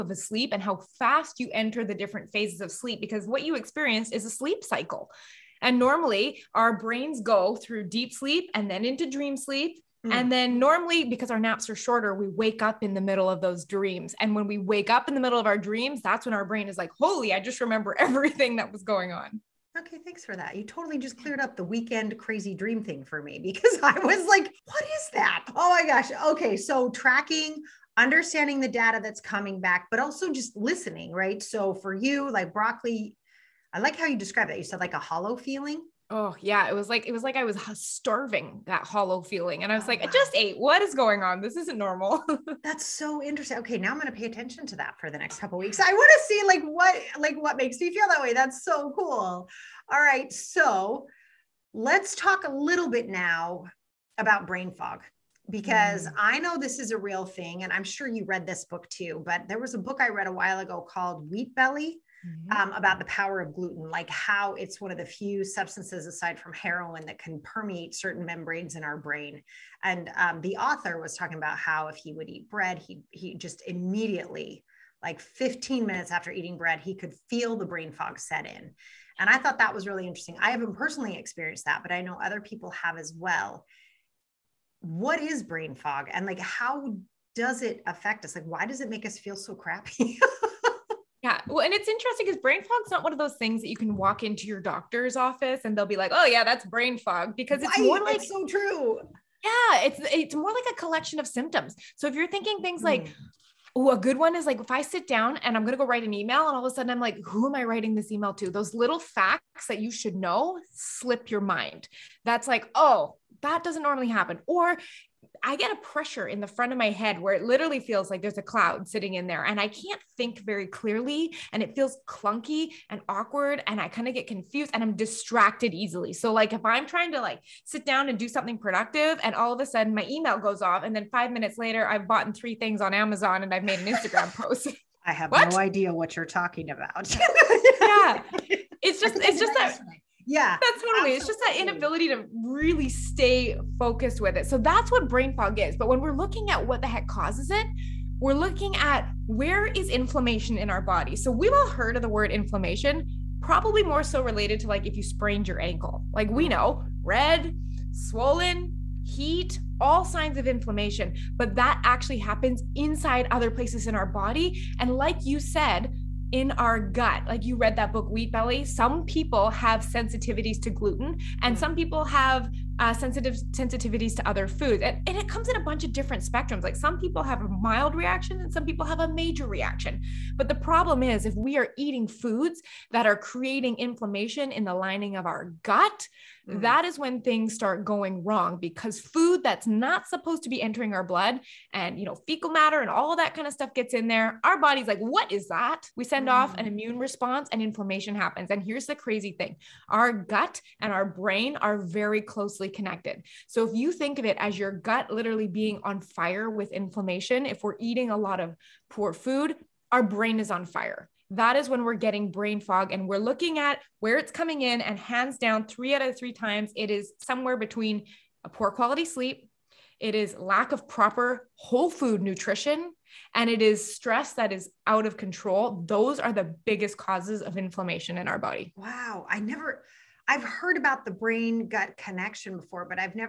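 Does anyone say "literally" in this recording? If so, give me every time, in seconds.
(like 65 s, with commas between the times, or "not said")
117 s, 205 s.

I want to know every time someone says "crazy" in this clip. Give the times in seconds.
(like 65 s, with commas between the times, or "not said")
22 s, 198 s.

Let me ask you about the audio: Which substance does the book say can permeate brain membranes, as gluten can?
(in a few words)
heroin.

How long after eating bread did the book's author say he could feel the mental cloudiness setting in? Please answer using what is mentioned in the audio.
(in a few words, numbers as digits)
15 minutes.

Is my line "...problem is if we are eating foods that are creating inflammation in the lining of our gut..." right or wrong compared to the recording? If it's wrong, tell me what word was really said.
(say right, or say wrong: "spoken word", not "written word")
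right.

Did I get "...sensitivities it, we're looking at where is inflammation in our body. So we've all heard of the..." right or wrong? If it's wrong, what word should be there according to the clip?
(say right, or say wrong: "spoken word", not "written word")
wrong: "causes", not "sensitivities".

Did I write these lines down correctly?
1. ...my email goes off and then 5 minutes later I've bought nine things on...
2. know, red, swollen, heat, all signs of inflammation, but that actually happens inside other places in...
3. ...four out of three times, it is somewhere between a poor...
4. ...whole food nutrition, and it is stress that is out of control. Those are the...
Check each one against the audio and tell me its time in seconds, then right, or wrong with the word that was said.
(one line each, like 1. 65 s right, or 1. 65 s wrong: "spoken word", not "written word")
1. 129 s wrong: "three", not "nine"
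2. 156 s right
3. 215 s wrong: "three", not "four"
4. 221 s right.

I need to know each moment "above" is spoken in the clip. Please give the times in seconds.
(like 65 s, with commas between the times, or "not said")
not said.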